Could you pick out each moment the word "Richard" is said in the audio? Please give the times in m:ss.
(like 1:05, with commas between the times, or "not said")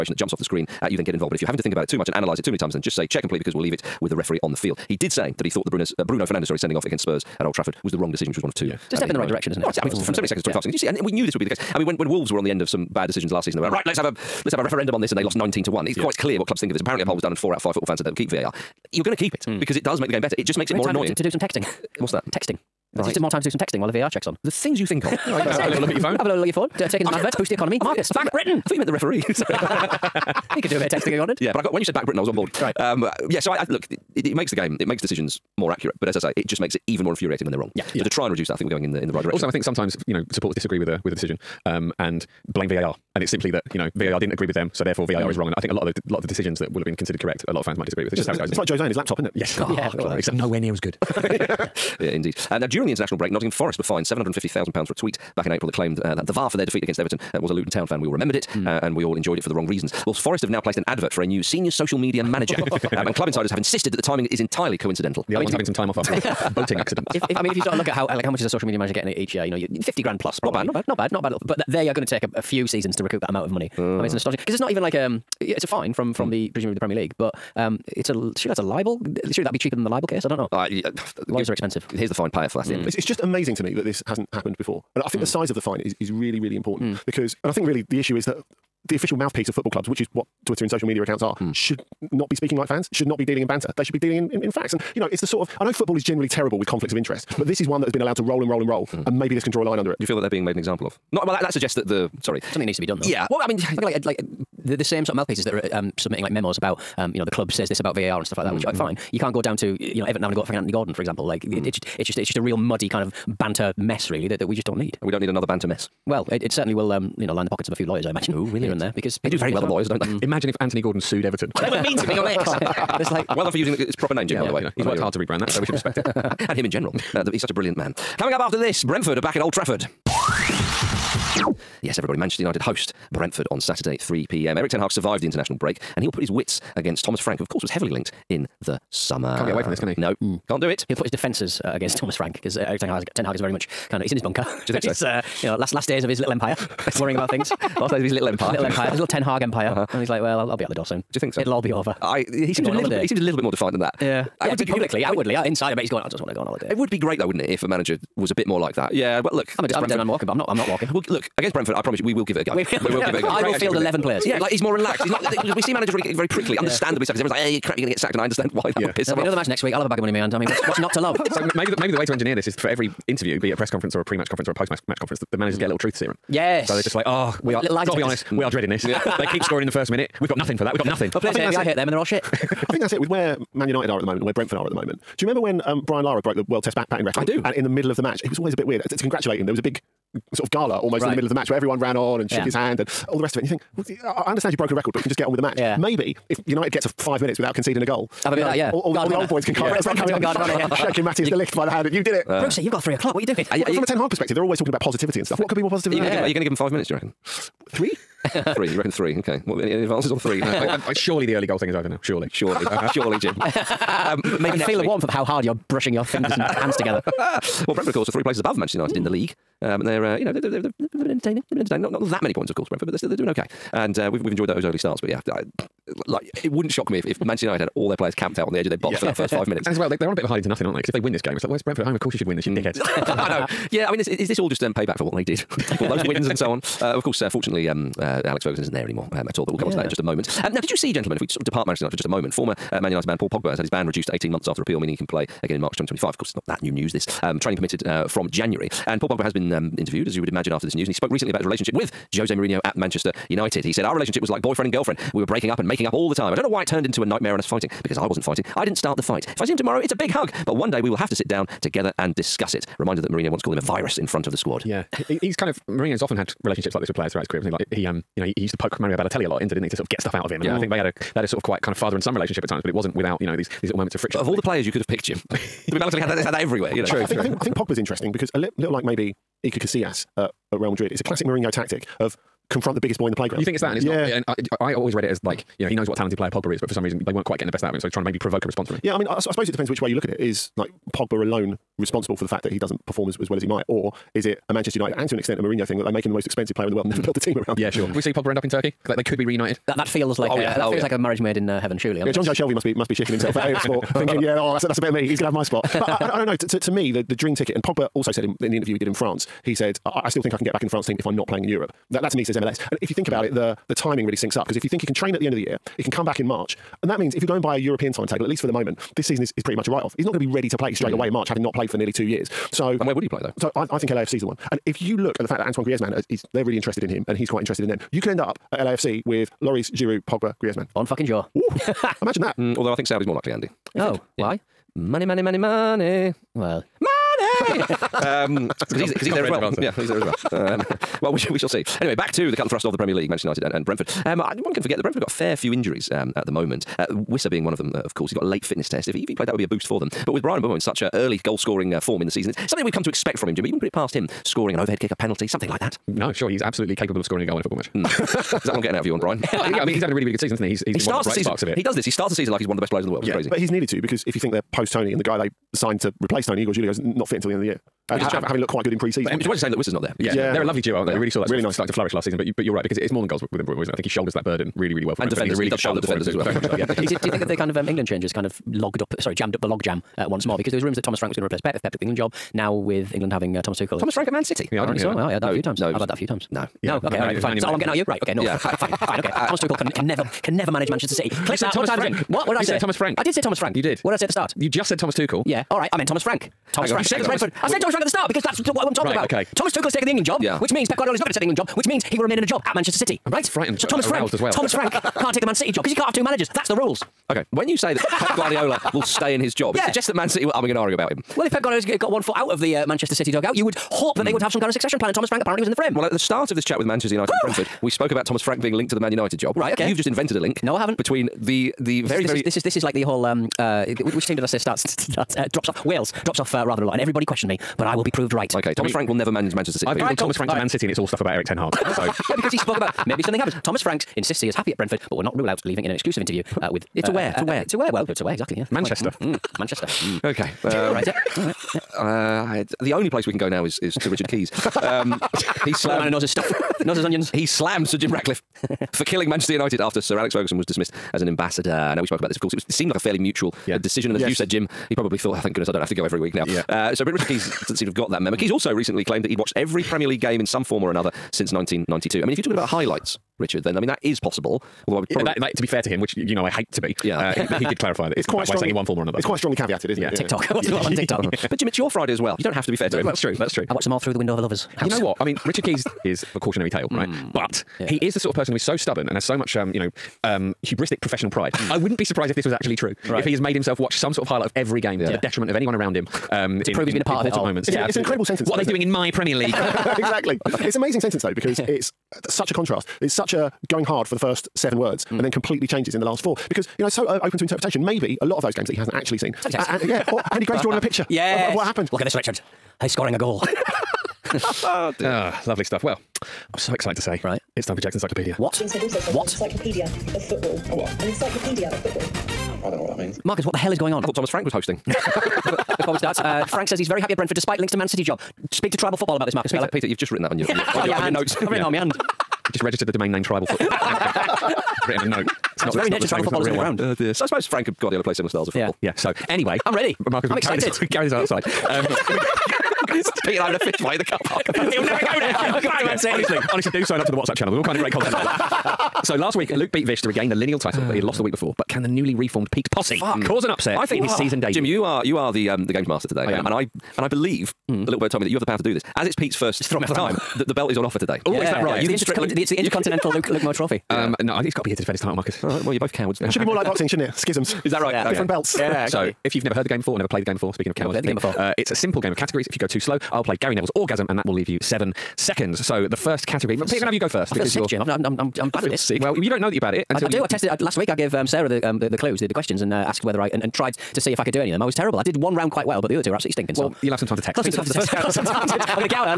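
7:23, 7:36, 7:43, 7:55, 8:21.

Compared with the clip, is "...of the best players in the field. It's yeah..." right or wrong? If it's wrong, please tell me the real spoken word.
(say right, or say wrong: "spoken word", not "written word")
wrong: "world", not "field".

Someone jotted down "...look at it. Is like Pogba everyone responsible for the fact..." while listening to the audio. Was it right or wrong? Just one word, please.
wrong.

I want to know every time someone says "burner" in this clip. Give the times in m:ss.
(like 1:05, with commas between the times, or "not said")
not said.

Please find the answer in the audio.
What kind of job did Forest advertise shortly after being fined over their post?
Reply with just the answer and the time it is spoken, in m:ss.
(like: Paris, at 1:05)
senior social media manager, at 1:01.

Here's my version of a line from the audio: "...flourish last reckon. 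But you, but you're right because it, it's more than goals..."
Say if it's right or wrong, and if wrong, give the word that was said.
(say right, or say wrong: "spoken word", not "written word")
wrong: "season", not "reckon".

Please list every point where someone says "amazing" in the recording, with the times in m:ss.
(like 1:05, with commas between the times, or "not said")
1:23, 8:10.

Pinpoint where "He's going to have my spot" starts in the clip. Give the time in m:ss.
5:05.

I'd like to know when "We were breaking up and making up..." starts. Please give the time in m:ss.
4:15.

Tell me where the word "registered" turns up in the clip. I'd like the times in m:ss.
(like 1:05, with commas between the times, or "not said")
8:42.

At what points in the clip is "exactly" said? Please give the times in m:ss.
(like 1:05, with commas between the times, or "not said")
7:18, 8:09, 9:18.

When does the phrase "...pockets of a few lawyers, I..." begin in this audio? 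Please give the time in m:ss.
1:57.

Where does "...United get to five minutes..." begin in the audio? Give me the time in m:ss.
3:16.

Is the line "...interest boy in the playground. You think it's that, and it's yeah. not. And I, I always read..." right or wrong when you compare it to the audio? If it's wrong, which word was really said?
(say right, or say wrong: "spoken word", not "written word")
wrong: "biggest", not "interest".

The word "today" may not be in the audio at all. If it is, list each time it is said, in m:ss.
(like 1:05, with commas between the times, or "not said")
9:05, 9:10.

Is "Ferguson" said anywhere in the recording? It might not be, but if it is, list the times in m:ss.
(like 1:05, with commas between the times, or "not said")
3:58, 7:30.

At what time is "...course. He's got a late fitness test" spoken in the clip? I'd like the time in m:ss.
5:47.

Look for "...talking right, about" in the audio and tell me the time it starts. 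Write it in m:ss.
6:38.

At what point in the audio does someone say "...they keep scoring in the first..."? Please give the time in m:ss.
2:59.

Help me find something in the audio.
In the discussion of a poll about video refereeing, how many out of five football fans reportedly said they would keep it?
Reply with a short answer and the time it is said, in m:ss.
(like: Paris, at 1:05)
4, at 0:17.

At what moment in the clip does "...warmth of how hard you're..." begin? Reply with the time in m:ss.
3:34.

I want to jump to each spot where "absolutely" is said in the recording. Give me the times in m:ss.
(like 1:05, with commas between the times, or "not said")
5:56, 9:35.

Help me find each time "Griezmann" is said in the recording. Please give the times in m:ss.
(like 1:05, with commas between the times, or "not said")
5:25, 5:30.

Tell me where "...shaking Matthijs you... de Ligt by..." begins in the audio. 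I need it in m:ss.
3:20.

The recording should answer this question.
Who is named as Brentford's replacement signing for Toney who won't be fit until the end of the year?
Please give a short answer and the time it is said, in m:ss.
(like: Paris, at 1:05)
Igor Julio, at 6:06.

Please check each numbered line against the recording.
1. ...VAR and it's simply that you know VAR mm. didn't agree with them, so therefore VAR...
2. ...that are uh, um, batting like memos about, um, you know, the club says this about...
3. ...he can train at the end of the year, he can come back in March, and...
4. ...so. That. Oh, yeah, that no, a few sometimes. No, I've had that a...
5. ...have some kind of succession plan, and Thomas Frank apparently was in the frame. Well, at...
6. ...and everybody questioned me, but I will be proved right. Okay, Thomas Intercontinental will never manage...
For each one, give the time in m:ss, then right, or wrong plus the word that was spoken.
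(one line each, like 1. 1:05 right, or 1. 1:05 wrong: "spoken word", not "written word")
1. 0:42 right
2. 1:45 wrong: "submitting", not "batting"
3. 5:14 right
4. 6:24 wrong: "times", not "sometimes"
5. 6:54 right
6. 7:06 wrong: "Frank", not "Intercontinental".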